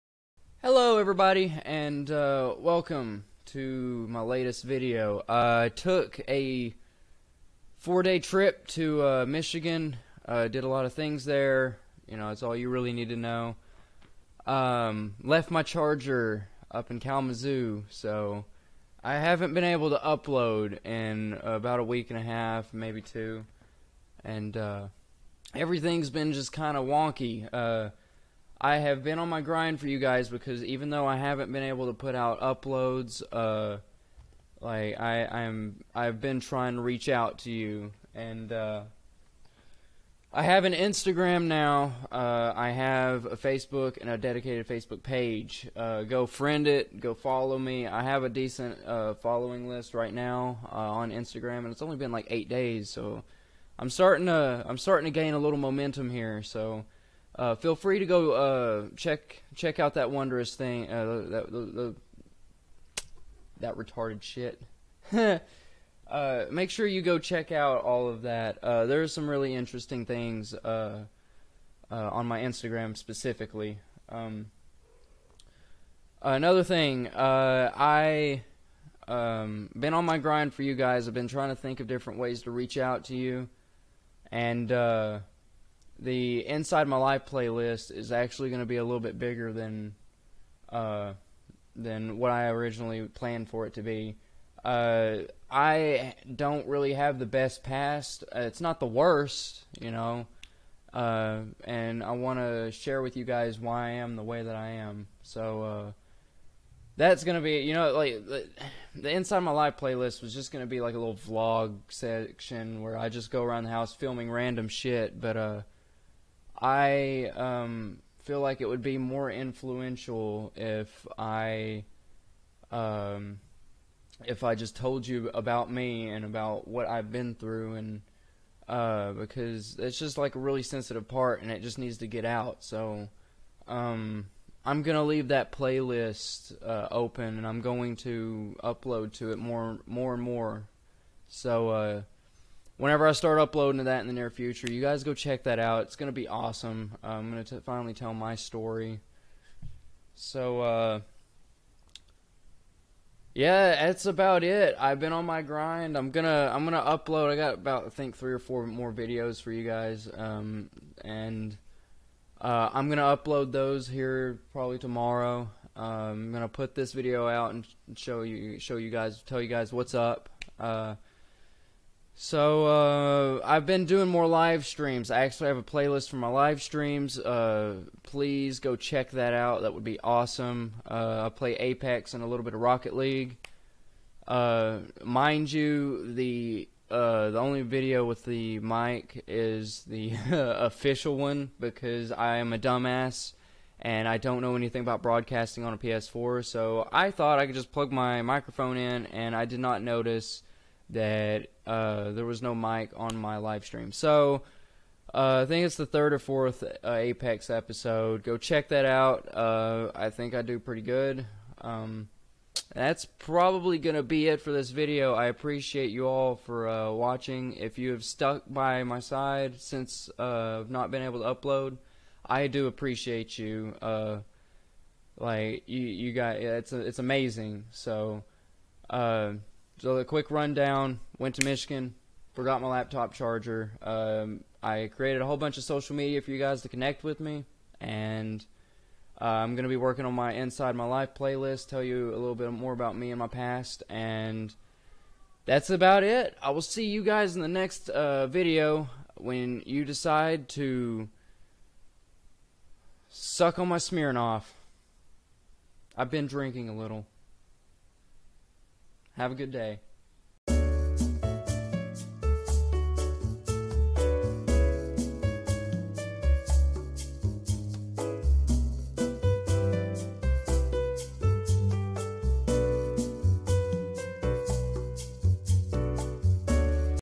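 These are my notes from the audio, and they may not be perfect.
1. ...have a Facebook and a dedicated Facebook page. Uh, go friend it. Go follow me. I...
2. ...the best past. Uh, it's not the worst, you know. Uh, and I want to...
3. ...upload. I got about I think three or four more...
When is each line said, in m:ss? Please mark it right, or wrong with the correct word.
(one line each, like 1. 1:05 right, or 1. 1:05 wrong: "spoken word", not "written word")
1. 0:42 right
2. 1:37 right
3. 2:36 right.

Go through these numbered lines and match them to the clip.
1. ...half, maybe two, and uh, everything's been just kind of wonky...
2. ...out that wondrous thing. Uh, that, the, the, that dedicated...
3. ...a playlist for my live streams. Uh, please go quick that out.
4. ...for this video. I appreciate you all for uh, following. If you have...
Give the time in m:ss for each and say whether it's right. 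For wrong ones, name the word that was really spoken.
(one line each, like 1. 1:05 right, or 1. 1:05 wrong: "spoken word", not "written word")
1. 0:22 right
2. 0:59 wrong: "retarded", not "dedicated"
3. 2:55 wrong: "check", not "quick"
4. 3:34 wrong: "watching", not "following".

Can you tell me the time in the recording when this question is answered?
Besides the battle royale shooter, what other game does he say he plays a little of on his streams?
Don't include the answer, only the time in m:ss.
3:02.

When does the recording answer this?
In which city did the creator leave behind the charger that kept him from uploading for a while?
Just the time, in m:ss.
0:16.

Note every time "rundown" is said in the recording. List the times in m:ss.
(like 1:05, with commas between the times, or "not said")
3:50.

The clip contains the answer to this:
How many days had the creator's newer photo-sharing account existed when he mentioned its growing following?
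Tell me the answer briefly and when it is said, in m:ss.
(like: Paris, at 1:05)
8, at 0:52.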